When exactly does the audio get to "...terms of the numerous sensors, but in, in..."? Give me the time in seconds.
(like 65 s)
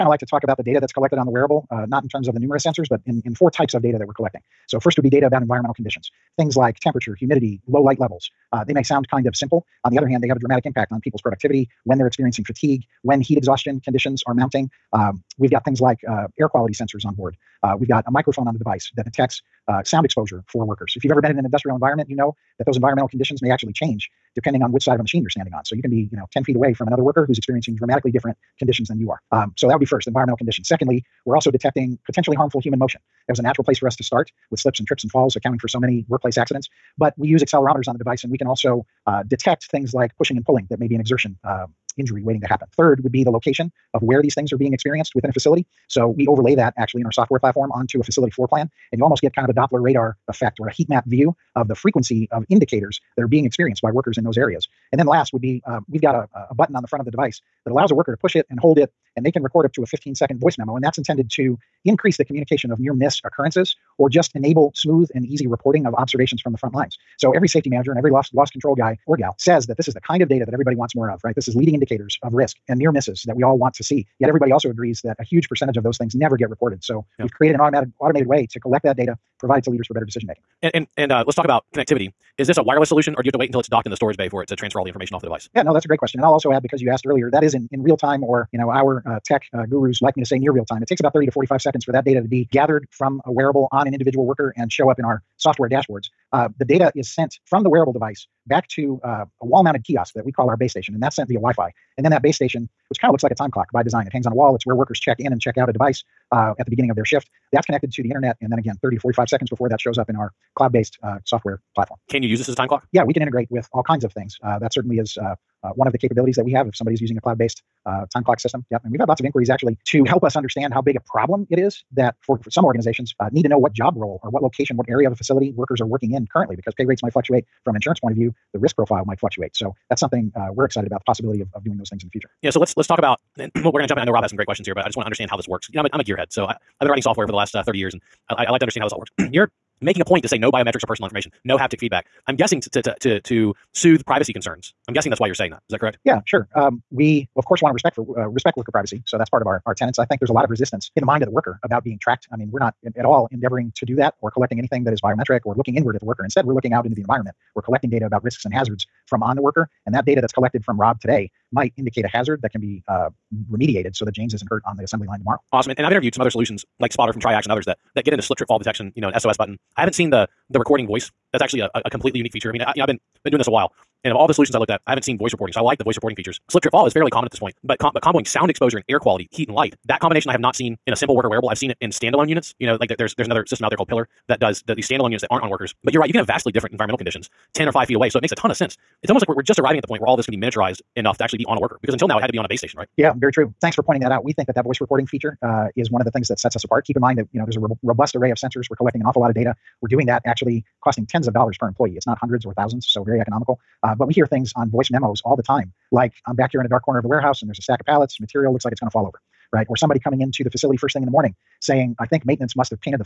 2 s.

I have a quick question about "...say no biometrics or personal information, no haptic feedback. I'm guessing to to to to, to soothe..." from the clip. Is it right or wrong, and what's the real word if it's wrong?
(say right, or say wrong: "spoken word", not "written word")
right.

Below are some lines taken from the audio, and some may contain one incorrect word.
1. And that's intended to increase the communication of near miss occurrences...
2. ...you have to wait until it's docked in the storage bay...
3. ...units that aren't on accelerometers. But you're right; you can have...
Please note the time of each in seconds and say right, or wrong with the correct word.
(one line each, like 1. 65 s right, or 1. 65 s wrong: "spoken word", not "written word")
1. 60 s right
2. 83 s right
3. 185 s wrong: "workers", not "accelerometers".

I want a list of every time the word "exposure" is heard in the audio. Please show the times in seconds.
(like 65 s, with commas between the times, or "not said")
20 s, 178 s.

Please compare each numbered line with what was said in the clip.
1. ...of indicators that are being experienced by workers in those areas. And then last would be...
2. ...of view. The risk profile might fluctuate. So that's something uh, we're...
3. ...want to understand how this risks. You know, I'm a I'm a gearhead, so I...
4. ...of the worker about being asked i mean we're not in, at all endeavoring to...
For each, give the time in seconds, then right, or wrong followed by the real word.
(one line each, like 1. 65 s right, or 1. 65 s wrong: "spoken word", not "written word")
1. 52 s right
2. 128 s right
3. 134 s wrong: "works", not "risks"
4. 151 s wrong: "tracked", not "asked".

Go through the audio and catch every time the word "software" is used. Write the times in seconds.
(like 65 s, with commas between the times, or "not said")
47 s, 95 s, 111 s, 137 s.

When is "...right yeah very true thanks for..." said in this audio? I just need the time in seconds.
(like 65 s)
192 s.